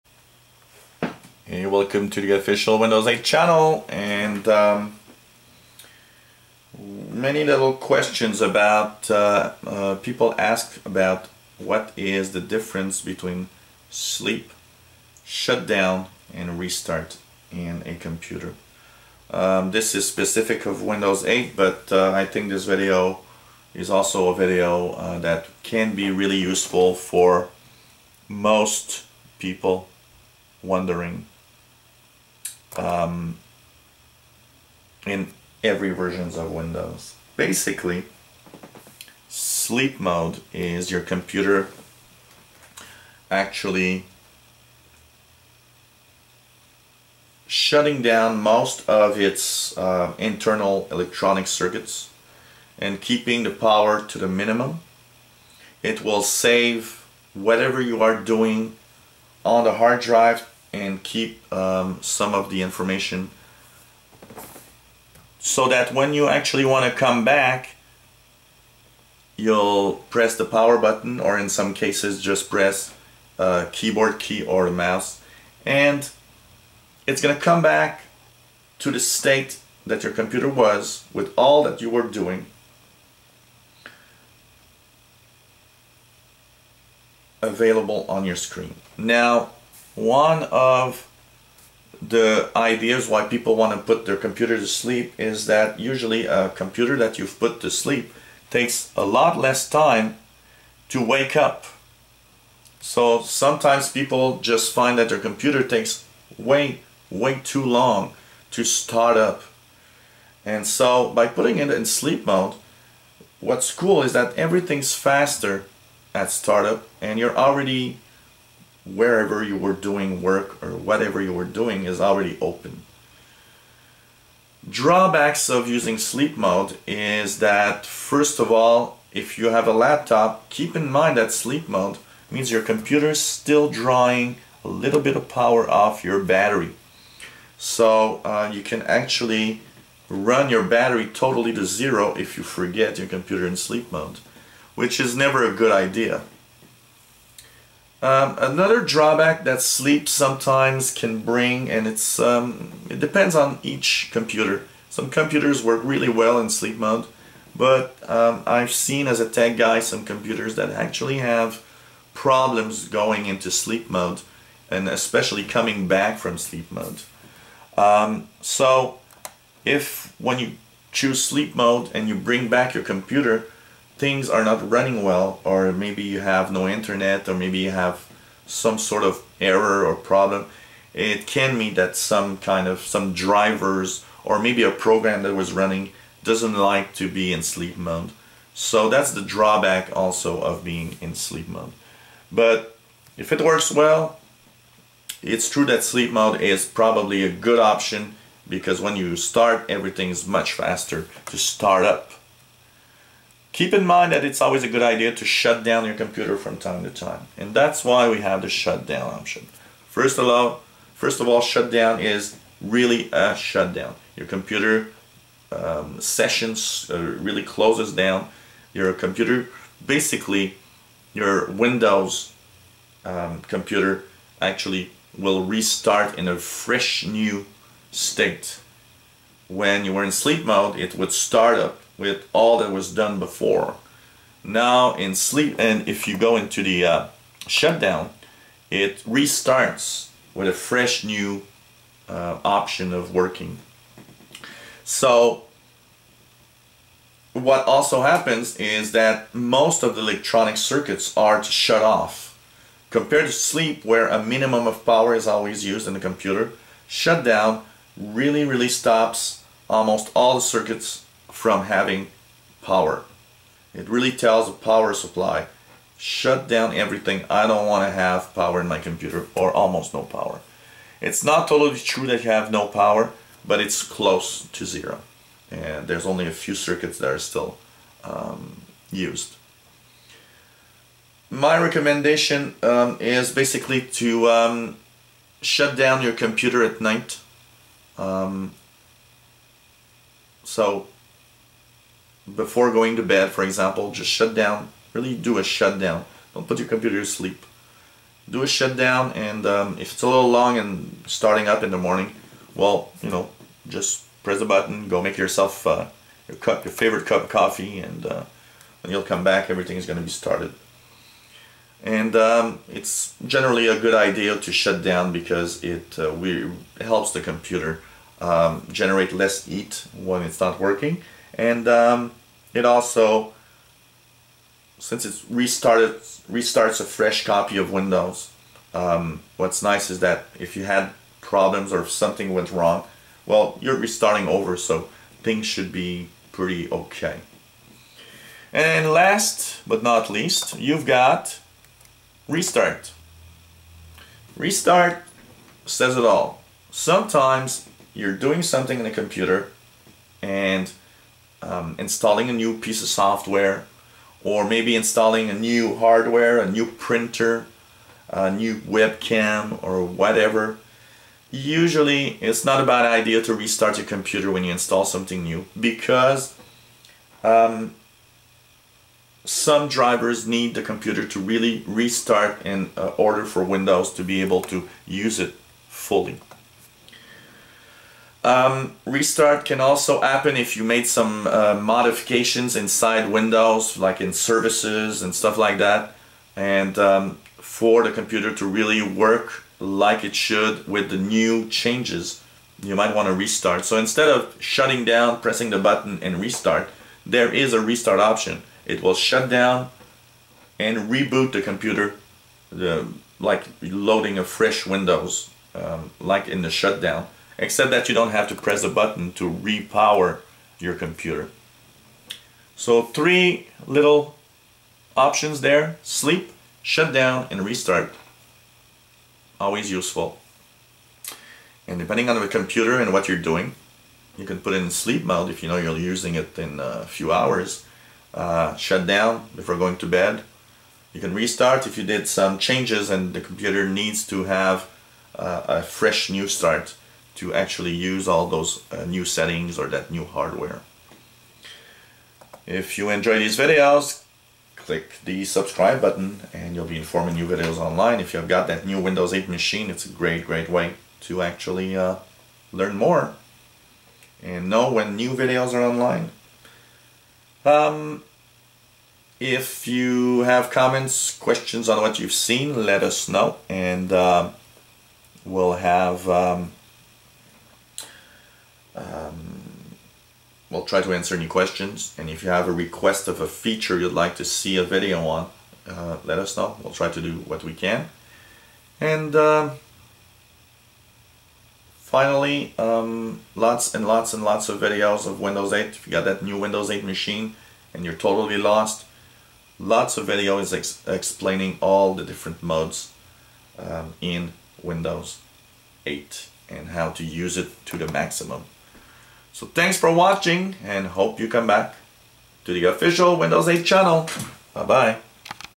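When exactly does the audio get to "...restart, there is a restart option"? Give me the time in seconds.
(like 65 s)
396 s.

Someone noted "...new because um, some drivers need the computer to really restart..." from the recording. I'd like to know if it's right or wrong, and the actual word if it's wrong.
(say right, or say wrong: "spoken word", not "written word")
right.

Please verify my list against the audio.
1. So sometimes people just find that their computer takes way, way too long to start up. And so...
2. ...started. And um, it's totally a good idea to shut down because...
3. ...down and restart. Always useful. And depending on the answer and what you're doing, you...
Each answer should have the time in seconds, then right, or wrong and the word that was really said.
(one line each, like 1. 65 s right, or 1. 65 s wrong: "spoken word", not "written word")
1. 102 s right
2. 310 s wrong: "generally", not "totally"
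3. 416 s wrong: "computer", not "answer".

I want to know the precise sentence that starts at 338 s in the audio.
And last but not least, you've got restart.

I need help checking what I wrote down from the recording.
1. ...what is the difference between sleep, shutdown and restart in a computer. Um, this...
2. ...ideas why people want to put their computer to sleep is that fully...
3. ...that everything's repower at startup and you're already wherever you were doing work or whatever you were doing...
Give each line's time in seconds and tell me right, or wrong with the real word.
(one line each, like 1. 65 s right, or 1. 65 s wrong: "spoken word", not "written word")
1. 11 s right
2. 92 s wrong: "usually", not "fully"
3. 114 s wrong: "faster", not "repower".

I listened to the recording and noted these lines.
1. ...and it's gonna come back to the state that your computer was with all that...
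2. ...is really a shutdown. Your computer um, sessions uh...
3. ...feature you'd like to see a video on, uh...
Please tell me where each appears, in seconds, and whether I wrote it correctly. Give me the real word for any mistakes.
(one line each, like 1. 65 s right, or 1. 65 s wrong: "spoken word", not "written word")
1. 75 s right
2. 211 s right
3. 473 s right.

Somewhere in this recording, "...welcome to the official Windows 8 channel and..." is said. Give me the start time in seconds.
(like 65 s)
1 s.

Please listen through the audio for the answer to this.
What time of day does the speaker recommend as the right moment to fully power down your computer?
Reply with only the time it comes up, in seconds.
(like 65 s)
286 s.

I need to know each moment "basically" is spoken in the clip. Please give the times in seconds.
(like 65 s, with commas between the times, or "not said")
37 s, 219 s, 283 s.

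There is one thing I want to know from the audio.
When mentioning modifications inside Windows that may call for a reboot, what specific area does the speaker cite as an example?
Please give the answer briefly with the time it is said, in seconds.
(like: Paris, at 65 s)
services, at 383 s.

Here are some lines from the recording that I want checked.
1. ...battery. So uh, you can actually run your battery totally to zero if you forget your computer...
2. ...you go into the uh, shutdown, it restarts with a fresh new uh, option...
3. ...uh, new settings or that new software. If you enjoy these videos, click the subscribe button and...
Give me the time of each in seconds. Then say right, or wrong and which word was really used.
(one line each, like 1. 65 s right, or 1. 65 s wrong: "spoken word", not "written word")
1. 136 s right
2. 236 s right
3. 438 s wrong: "hardware", not "software".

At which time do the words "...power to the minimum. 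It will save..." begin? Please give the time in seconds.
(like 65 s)
53 s.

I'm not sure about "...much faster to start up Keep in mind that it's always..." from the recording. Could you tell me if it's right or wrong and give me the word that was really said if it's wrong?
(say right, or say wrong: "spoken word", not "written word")
right.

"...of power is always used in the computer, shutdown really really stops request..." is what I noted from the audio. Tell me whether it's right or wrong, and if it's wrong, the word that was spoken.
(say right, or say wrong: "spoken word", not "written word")
wrong: "almost", not "request".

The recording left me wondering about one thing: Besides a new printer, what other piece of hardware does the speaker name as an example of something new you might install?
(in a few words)
webcam.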